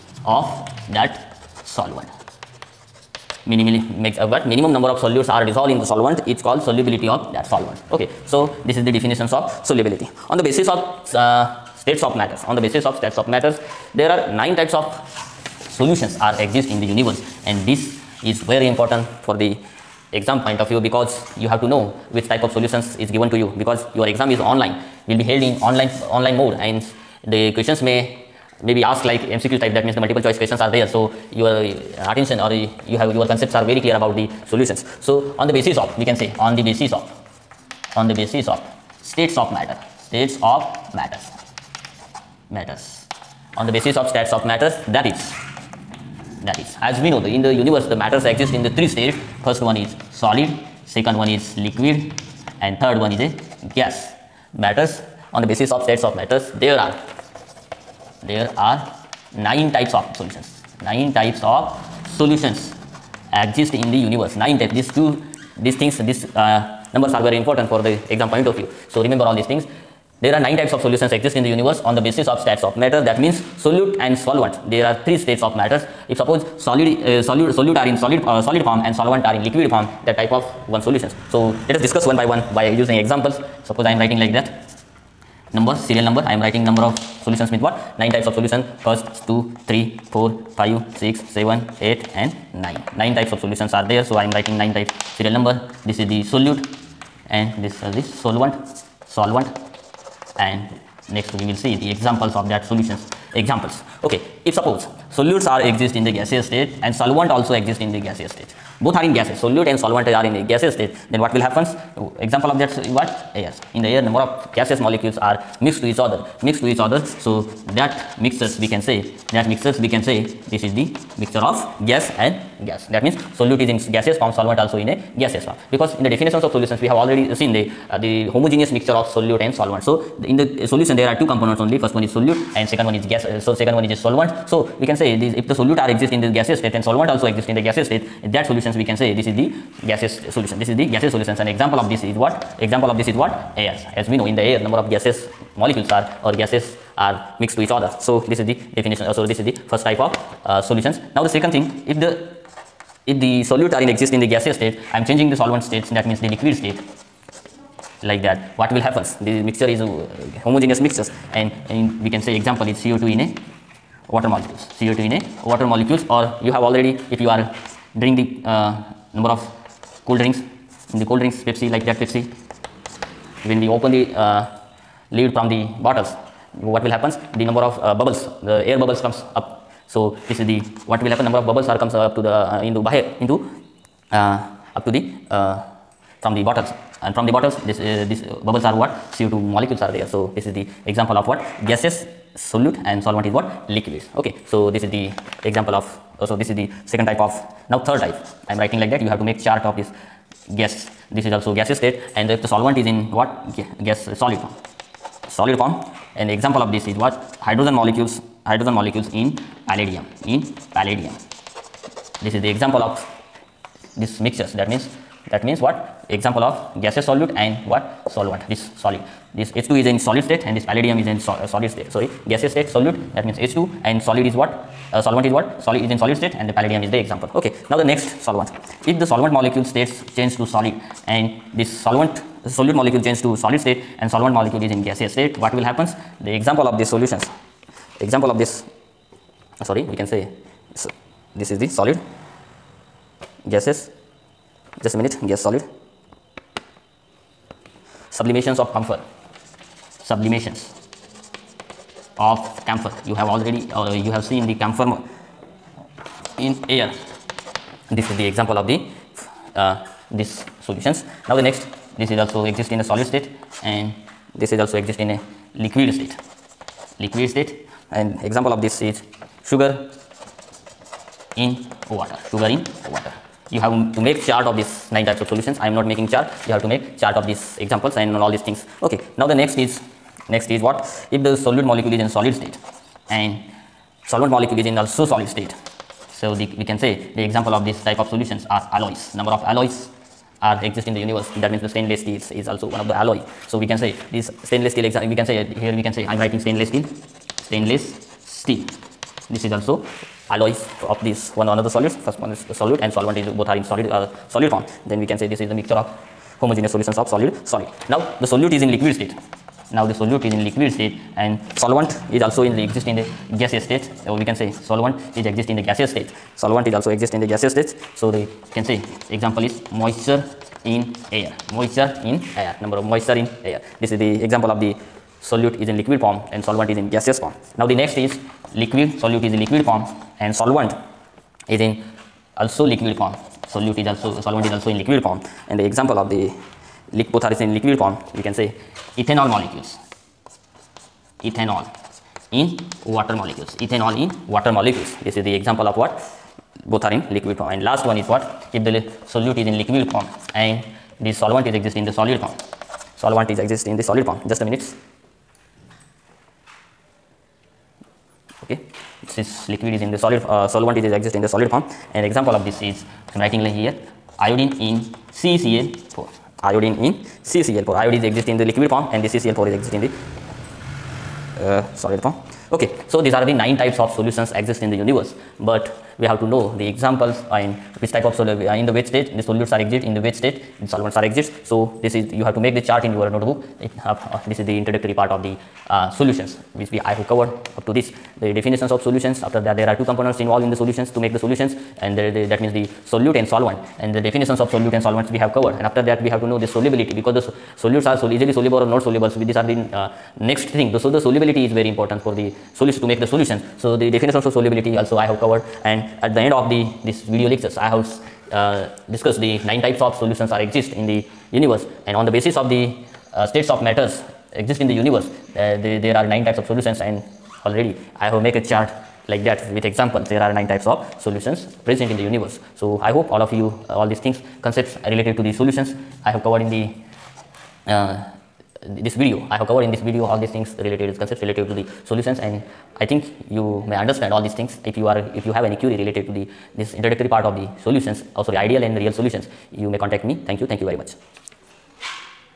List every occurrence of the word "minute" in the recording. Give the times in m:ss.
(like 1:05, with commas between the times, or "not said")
4:04, 5:54.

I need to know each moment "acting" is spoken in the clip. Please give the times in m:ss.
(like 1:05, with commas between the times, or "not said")
not said.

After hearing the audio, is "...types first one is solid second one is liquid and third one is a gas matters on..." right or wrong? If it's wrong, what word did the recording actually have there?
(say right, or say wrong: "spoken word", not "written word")
wrong: "states", not "types".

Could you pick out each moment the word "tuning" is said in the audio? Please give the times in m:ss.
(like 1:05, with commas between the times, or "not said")
not said.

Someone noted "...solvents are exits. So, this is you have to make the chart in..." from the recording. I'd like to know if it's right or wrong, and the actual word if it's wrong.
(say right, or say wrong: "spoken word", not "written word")
right.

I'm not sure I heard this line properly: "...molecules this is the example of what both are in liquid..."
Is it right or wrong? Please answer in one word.
right.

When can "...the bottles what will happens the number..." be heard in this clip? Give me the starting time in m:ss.
2:55.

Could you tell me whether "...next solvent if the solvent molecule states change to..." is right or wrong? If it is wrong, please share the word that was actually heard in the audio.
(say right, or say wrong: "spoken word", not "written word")
right.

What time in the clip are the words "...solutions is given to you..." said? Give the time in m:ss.
0:22.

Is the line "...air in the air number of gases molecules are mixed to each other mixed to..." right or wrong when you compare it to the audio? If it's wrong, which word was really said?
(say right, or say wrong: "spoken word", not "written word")
right.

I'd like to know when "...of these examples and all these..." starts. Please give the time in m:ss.
4:37.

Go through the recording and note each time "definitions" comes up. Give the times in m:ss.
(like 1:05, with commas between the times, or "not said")
0:08, 2:06, 2:28, 6:28, 6:34, 6:43.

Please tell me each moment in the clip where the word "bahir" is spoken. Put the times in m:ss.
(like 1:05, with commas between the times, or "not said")
3:02.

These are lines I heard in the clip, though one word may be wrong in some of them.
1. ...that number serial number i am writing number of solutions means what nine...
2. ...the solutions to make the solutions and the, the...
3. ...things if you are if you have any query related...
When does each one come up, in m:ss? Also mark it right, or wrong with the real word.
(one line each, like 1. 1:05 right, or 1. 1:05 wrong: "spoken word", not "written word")
1. 1:24 right
2. 6:30 right
3. 7:14 right.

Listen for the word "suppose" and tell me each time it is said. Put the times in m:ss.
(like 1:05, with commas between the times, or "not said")
1:16, 1:23, 1:44.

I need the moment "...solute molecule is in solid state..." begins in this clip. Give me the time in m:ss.
4:41.